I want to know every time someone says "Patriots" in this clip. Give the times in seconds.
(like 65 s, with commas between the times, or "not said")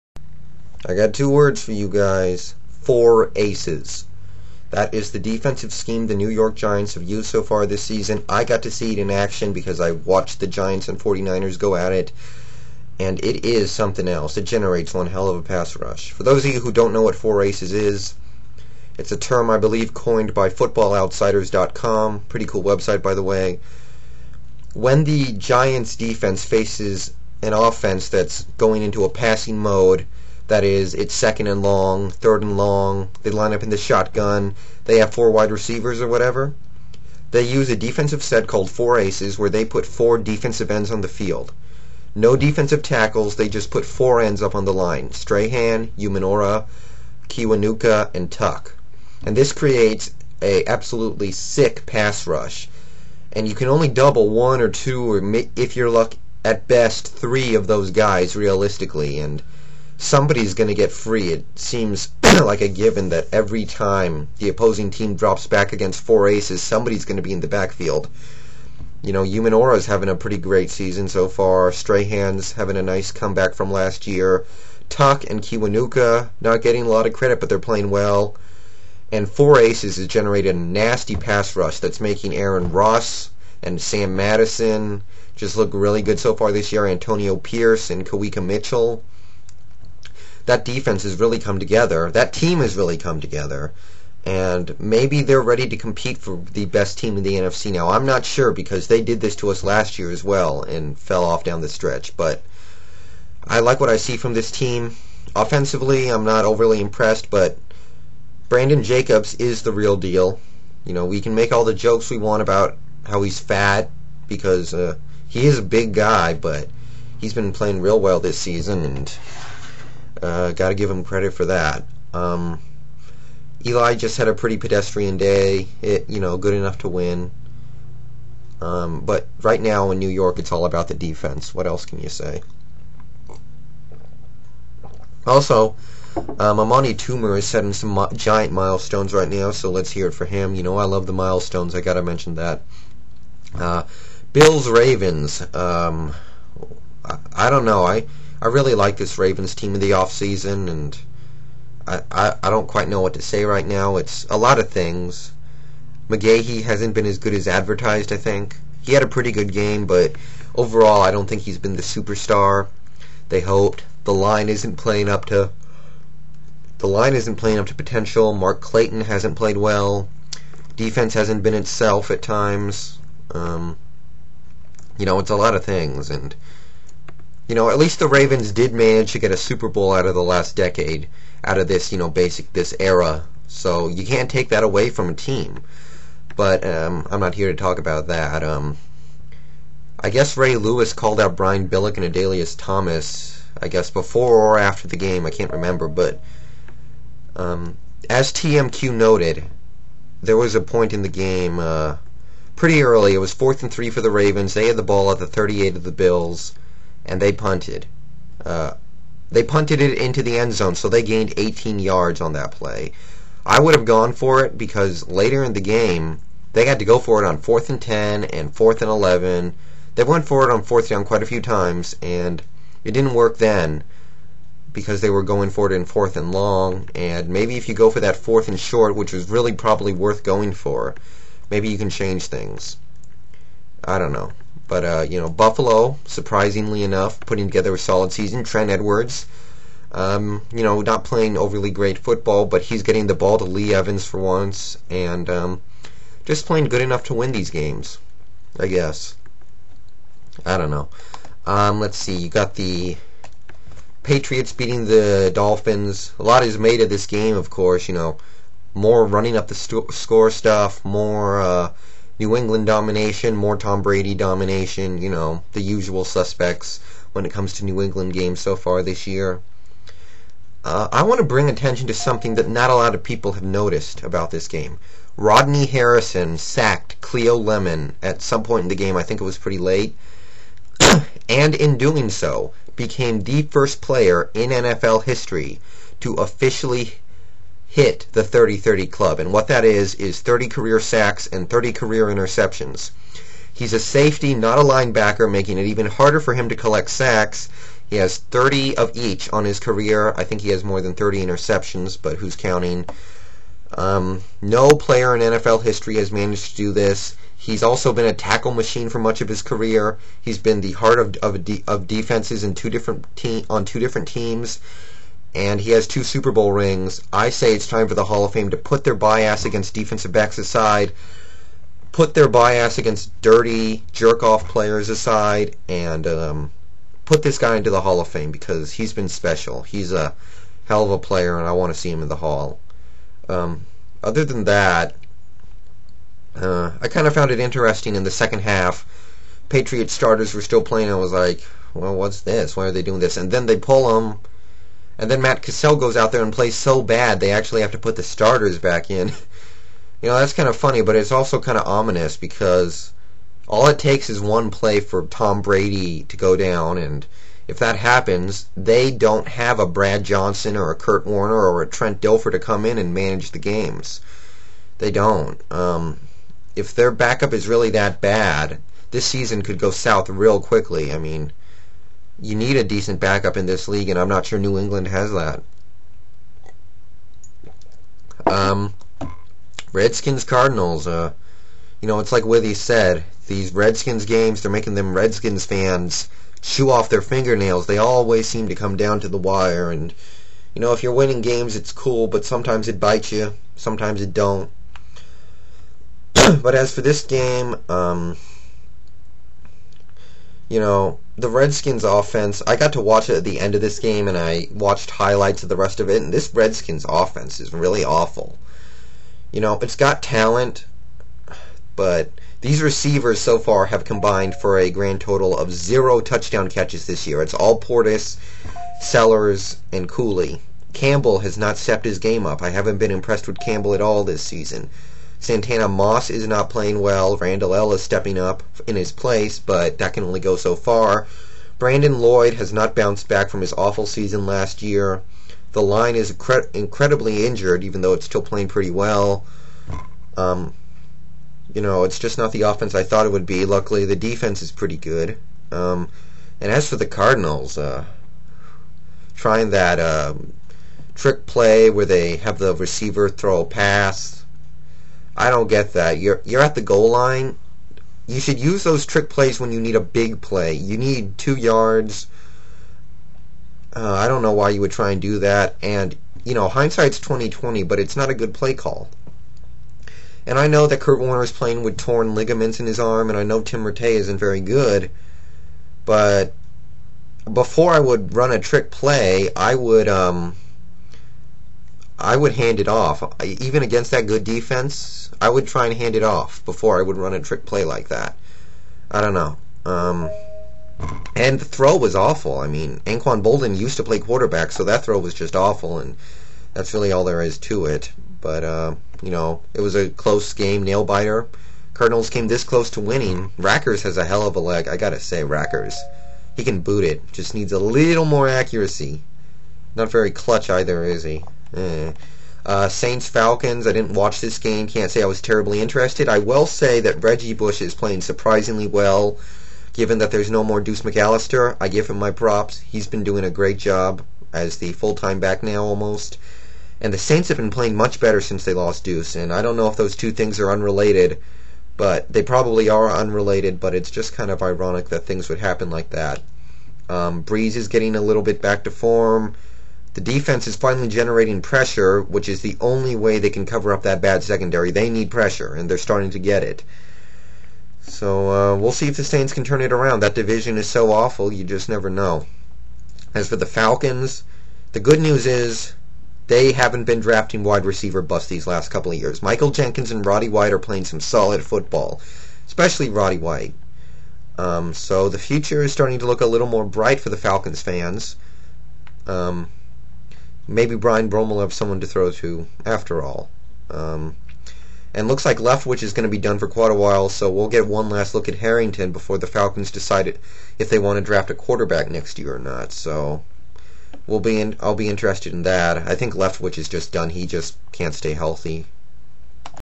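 254 s, 339 s.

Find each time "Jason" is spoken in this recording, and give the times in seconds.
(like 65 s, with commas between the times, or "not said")
not said.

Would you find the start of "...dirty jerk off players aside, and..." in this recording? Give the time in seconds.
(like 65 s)
323 s.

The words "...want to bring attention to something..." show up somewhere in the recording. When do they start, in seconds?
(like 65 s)
271 s.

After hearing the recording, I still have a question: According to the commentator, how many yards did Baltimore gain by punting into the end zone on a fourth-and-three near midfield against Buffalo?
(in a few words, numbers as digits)
18.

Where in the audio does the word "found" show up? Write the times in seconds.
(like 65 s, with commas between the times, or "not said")
337 s.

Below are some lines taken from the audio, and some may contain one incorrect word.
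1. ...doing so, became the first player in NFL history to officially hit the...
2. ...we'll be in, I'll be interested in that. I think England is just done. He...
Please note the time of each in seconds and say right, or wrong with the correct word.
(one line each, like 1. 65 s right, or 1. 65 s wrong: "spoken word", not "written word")
1. 281 s right
2. 584 s wrong: "Leftwich", not "England".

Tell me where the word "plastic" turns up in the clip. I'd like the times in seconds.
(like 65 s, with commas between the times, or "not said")
not said.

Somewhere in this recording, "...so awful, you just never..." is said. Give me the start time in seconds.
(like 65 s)
550 s.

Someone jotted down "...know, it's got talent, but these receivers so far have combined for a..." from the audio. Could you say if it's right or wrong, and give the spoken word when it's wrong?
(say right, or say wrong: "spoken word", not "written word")
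right.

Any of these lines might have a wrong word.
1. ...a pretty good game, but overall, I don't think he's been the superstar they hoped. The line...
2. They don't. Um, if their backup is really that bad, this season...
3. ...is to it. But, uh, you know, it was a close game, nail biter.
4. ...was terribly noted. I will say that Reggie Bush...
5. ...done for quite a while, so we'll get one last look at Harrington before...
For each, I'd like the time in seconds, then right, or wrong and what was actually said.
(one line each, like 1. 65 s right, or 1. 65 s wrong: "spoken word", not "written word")
1. 159 s right
2. 364 s right
3. 497 s right
4. 515 s wrong: "interested", not "noted"
5. 576 s right.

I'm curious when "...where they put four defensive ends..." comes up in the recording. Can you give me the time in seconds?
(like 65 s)
39 s.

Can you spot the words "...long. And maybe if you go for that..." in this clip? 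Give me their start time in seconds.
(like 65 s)
226 s.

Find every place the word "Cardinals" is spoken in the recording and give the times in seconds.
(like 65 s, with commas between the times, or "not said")
380 s, 446 s, 501 s.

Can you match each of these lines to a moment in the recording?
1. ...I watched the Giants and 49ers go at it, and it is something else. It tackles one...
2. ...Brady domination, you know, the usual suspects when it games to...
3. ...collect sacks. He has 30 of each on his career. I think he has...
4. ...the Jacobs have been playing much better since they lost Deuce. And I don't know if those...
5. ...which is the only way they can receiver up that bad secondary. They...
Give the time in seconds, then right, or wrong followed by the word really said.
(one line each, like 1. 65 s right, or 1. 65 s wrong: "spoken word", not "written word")
1. 9 s wrong: "generates", not "tackles"
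2. 263 s wrong: "comes", not "games"
3. 296 s right
4. 526 s wrong: "Saints", not "Jacobs"
5. 542 s wrong: "cover", not "receiver".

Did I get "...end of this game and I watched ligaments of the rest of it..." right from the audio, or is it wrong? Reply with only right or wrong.
wrong.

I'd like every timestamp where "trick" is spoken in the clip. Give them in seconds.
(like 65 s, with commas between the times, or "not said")
450 s, 458 s, 478 s, 487 s.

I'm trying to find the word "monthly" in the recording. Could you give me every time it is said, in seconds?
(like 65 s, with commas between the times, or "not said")
not said.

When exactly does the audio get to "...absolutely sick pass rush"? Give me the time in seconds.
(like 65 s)
50 s.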